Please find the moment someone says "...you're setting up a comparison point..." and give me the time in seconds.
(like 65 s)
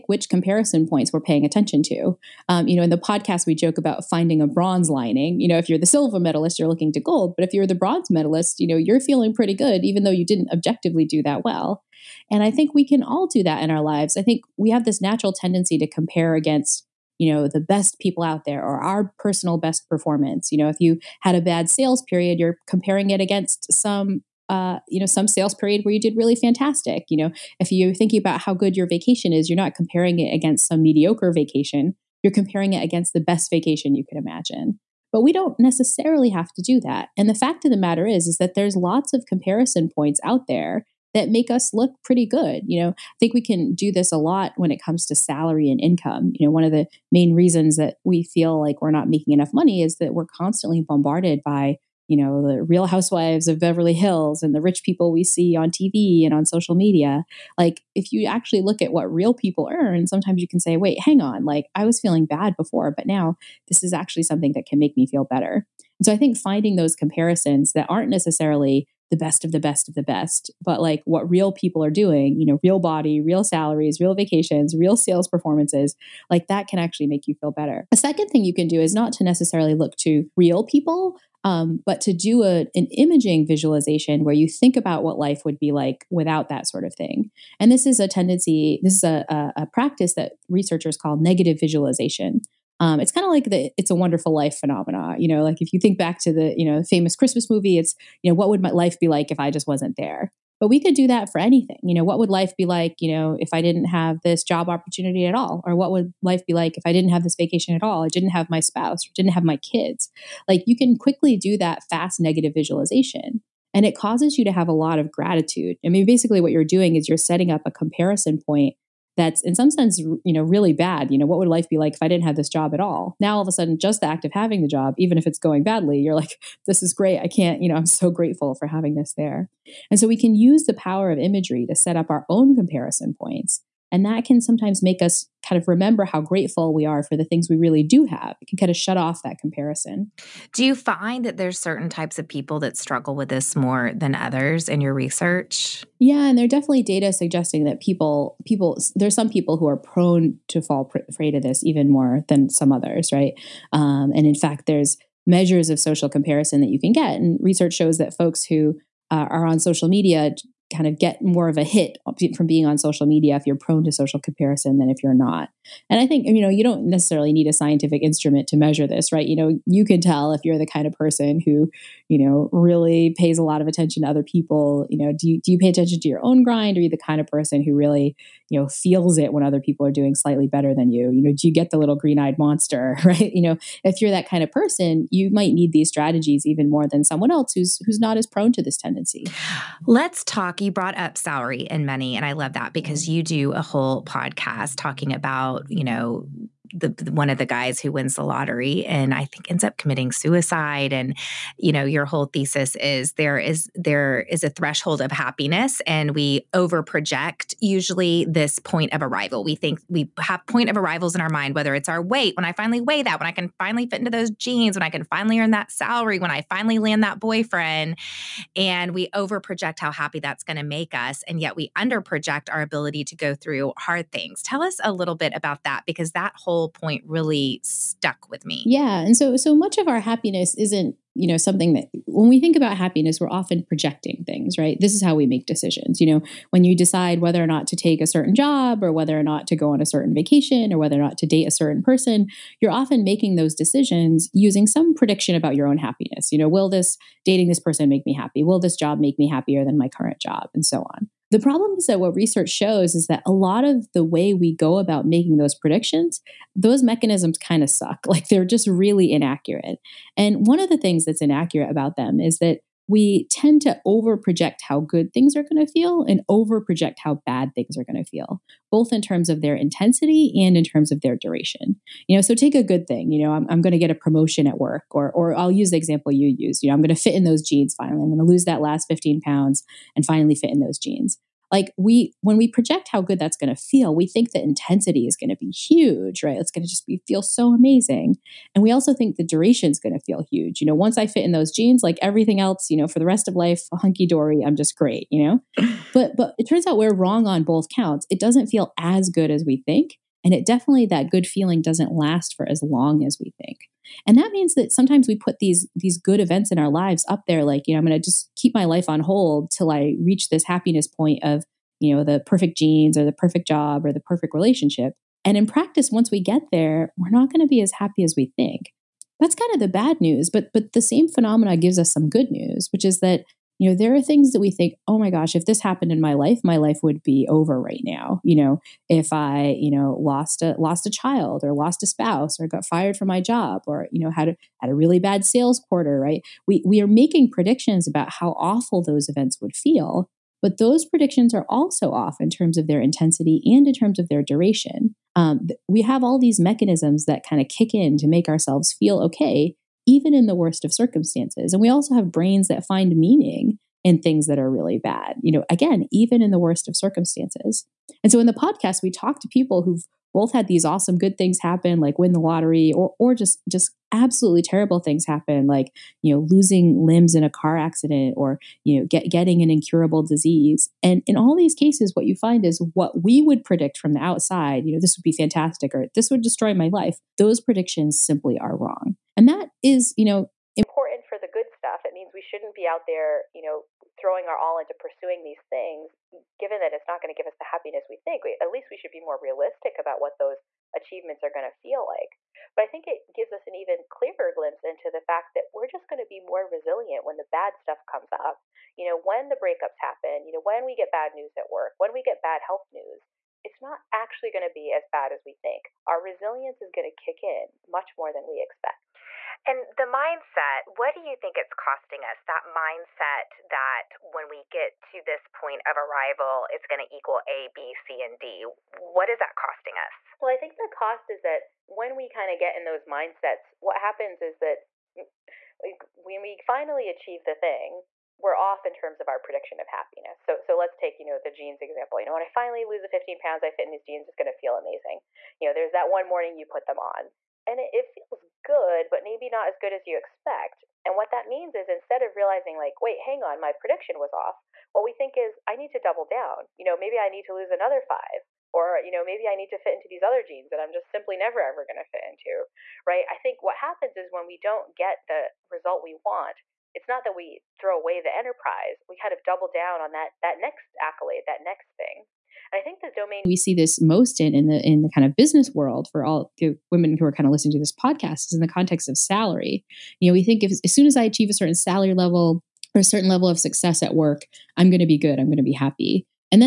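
117 s.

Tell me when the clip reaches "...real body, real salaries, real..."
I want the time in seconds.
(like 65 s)
72 s.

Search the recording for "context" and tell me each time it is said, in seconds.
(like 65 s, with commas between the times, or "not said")
468 s.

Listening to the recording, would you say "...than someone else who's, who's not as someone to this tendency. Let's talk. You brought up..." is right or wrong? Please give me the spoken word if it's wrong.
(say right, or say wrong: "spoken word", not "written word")
wrong: "prone", not "someone".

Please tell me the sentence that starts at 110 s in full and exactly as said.
Like you can quickly do that fast negative visualization.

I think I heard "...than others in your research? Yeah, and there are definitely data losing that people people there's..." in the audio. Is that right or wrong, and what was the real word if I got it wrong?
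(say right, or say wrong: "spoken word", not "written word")
wrong: "suggesting", not "losing".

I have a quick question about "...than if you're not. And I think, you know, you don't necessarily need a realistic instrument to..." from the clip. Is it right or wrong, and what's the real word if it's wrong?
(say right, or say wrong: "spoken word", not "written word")
wrong: "scientific", not "realistic".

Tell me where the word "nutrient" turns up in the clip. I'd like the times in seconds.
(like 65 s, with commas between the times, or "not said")
not said.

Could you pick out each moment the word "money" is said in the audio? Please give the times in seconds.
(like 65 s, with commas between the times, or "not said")
49 s, 191 s.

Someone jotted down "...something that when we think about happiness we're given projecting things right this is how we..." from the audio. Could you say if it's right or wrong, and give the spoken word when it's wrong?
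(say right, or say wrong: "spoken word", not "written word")
wrong: "often", not "given".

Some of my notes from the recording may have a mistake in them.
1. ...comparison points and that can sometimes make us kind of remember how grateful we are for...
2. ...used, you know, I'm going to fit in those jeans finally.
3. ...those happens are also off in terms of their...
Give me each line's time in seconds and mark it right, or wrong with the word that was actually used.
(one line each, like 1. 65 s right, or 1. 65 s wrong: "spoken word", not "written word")
1. 132 s right
2. 276 s right
3. 340 s wrong: "predictions", not "happens".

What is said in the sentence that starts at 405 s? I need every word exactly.
Our resilience is going to kick in much more than we expect.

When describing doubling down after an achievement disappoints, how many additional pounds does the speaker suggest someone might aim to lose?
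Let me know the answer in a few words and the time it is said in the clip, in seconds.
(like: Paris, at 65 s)
5, at 447 s.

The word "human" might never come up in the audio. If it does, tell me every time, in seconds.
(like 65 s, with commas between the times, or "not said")
not said.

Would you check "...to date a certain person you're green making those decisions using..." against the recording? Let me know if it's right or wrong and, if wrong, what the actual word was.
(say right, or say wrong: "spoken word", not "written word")
wrong: "often", not "green".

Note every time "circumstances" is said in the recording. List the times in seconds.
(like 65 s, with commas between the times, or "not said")
350 s, 356 s.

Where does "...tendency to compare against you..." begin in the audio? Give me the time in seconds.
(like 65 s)
15 s.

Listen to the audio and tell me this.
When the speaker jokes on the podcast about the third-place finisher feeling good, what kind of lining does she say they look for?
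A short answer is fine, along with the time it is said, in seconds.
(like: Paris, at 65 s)
bronze lining, at 4 s.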